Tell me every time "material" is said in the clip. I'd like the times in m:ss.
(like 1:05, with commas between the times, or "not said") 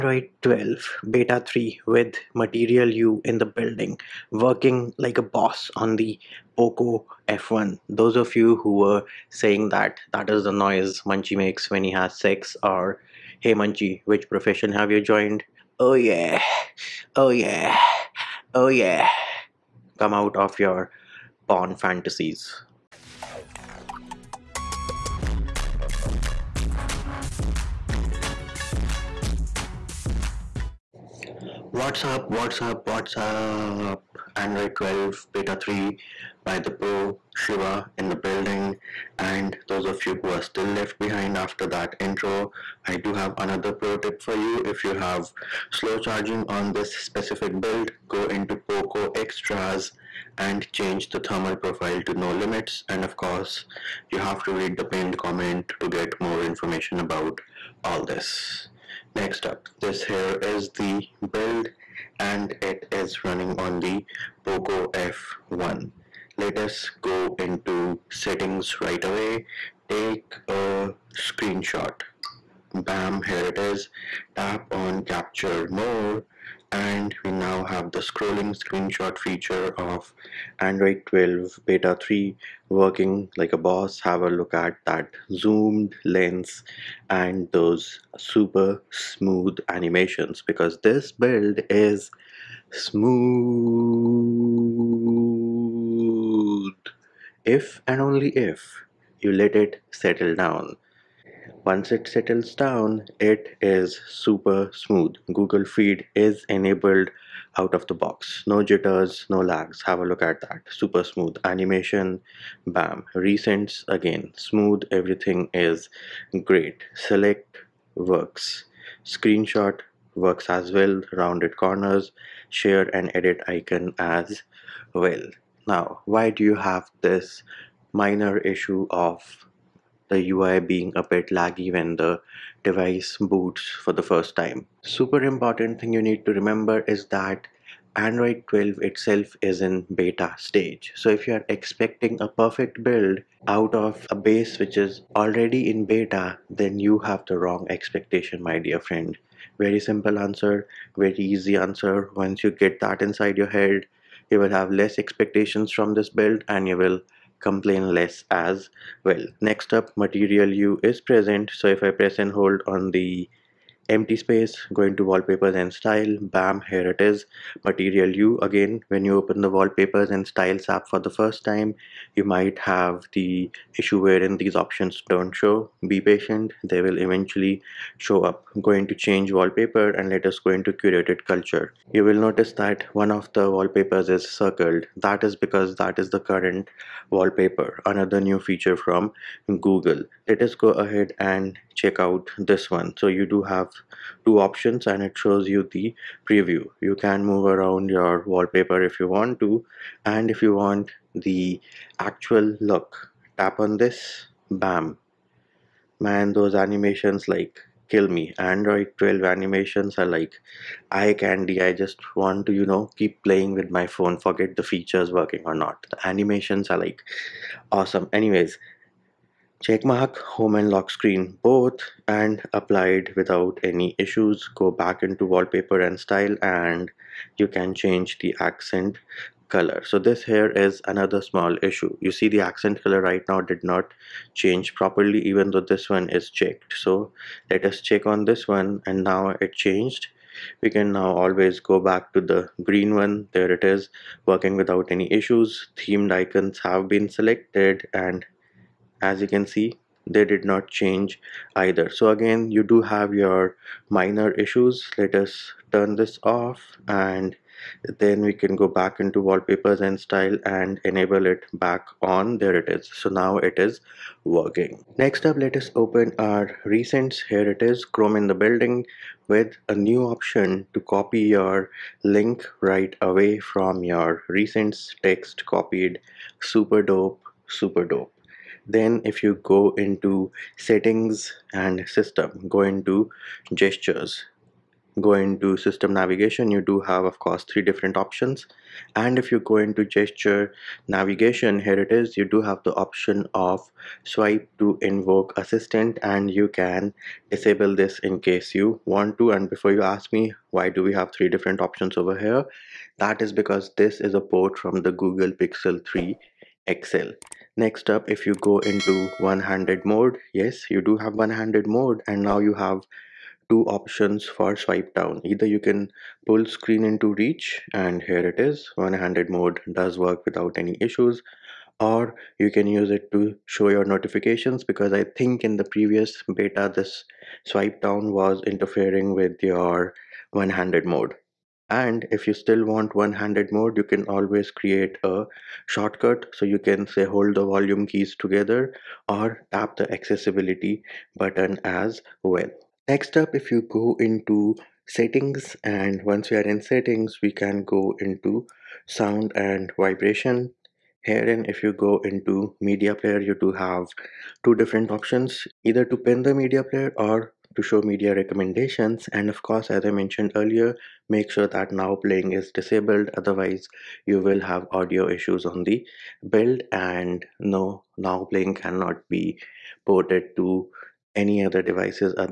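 0:02, 2:39, 2:47.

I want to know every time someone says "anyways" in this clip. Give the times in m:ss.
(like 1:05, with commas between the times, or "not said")
3:38.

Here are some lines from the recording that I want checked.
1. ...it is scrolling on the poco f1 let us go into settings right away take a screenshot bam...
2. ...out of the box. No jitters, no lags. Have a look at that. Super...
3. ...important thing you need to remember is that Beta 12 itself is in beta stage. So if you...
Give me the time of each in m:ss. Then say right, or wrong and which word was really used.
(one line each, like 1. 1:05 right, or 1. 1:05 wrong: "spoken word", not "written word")
1. 1:02 wrong: "running", not "scrolling"
2. 1:47 right
3. 2:15 wrong: "Android", not "Beta".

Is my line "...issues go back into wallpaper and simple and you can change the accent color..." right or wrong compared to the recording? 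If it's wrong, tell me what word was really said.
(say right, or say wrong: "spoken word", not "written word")
wrong: "style", not "simple".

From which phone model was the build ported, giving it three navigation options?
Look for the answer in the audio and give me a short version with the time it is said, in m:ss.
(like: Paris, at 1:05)
Google Pixel 3 XL, at 5:04.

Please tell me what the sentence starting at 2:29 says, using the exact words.
Very simple answer, very easy answer.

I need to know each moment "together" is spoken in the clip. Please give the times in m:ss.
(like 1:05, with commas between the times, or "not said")
5:38.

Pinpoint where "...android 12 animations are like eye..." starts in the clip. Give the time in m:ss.
3:28.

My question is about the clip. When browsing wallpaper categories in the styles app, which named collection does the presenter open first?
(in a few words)
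Curated Culture.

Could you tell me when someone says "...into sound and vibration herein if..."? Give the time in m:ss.
5:48.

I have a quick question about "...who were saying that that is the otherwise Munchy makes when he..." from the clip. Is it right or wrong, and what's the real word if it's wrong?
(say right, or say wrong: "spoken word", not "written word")
wrong: "noise", not "otherwise".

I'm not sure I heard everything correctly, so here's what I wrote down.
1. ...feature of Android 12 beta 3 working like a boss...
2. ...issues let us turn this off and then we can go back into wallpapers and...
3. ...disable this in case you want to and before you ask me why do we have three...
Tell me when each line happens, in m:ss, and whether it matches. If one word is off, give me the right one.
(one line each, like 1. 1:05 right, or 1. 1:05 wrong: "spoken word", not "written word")
1. 1:19 right
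2. 4:14 right
3. 4:57 right.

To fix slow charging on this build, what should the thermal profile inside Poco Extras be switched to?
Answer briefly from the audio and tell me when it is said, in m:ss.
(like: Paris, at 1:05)
No limits, at 0:52.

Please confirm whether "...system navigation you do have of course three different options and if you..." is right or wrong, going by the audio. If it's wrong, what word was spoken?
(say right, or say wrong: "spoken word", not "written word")
right.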